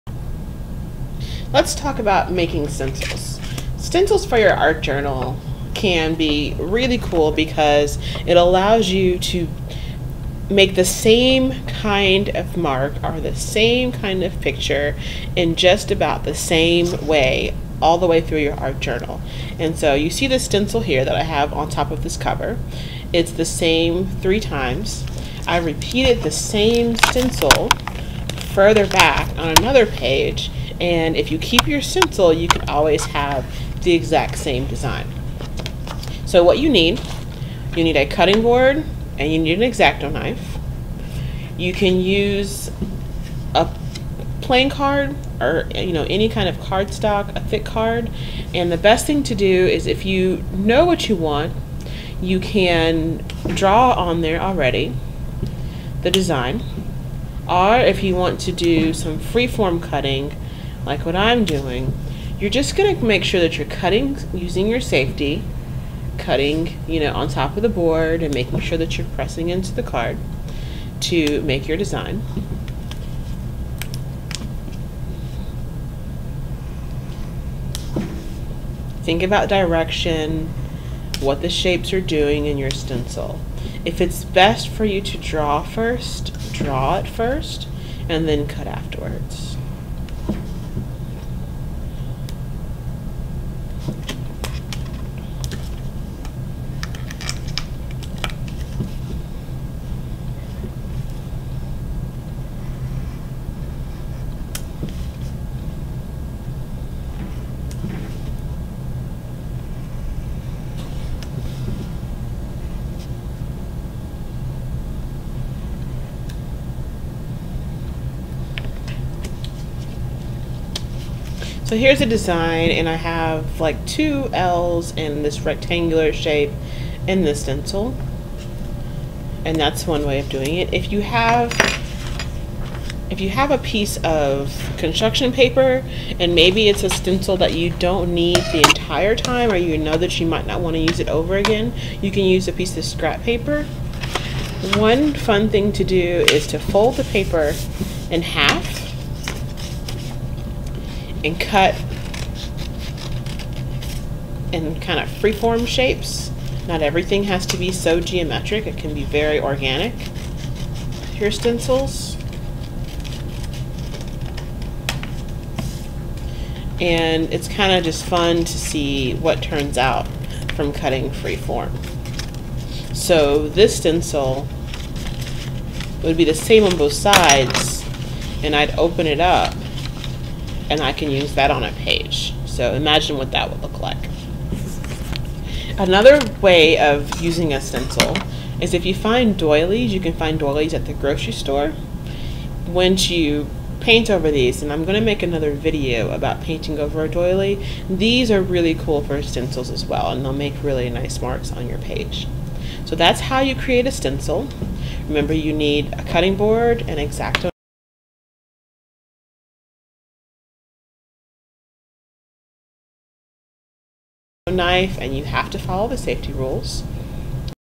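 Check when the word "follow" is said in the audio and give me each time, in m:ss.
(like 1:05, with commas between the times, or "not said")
3:35.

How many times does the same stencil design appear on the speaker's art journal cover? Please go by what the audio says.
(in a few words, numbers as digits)
3.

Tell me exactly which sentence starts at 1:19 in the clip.
Think about direction, what the shapes are doing in your stencil.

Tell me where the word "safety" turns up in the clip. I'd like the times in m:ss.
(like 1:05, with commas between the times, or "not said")
1:04, 3:35.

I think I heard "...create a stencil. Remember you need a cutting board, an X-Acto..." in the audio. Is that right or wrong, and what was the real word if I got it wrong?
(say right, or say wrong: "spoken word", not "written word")
right.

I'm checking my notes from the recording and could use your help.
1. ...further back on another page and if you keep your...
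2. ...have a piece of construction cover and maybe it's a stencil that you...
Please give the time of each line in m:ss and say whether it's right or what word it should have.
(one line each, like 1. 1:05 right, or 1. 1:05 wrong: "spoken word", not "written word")
1. 0:28 right
2. 2:13 wrong: "paper", not "cover".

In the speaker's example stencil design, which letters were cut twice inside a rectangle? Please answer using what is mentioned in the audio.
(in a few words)
L's.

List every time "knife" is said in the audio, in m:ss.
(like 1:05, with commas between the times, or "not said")
0:40, 3:34.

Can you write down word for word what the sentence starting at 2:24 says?
One fun thing to do is to fold the paper in half and cut in kind of freeform shapes.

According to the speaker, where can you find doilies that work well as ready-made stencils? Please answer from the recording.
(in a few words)
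the grocery store.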